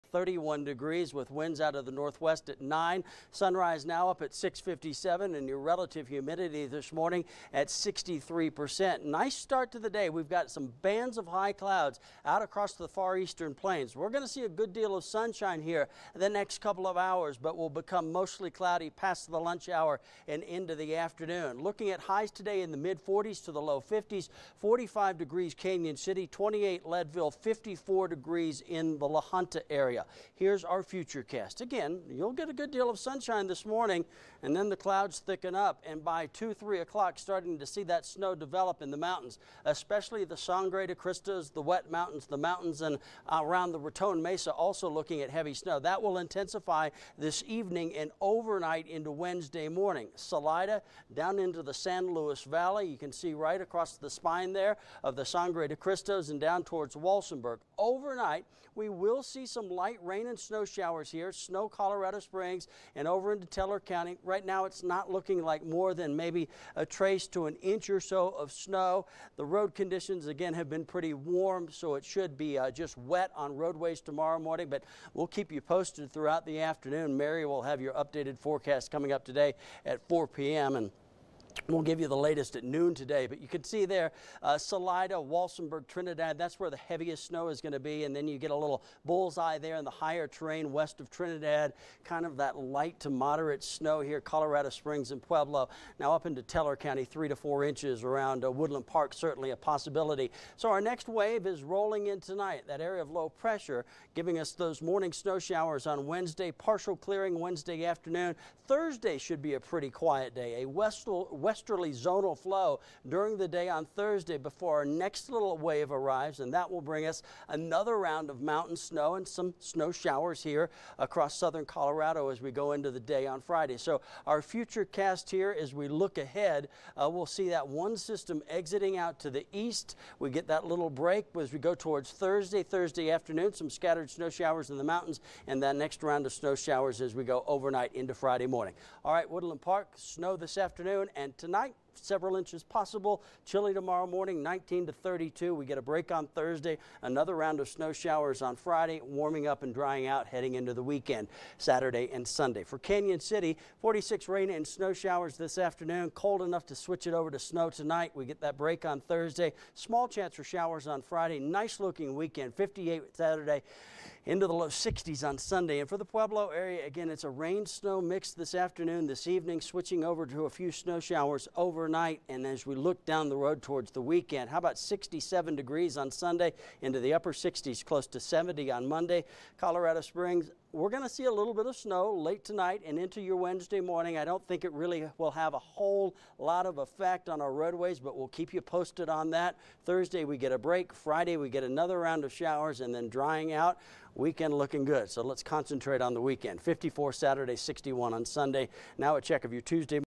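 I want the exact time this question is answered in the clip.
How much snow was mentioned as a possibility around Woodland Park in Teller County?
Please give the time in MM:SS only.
01:37.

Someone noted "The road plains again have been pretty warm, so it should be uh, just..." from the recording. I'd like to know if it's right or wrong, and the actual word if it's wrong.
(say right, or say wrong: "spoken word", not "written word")
wrong: "conditions", not "plains".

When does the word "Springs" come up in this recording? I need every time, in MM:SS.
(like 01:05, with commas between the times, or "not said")
01:02, 01:34, 03:00.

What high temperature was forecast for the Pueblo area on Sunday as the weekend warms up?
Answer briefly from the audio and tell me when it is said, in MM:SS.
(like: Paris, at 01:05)
67 degrees, at 02:54.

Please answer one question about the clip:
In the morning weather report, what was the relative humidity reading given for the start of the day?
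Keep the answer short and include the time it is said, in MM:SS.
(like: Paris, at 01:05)
63%, at 00:07.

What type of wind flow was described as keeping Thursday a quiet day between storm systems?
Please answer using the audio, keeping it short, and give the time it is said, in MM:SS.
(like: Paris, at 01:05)
westerly zonal flow, at 01:51.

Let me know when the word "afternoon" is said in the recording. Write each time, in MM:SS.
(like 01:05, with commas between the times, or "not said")
00:20, 01:16, 01:47, 02:13, 02:20, 02:35, 02:48.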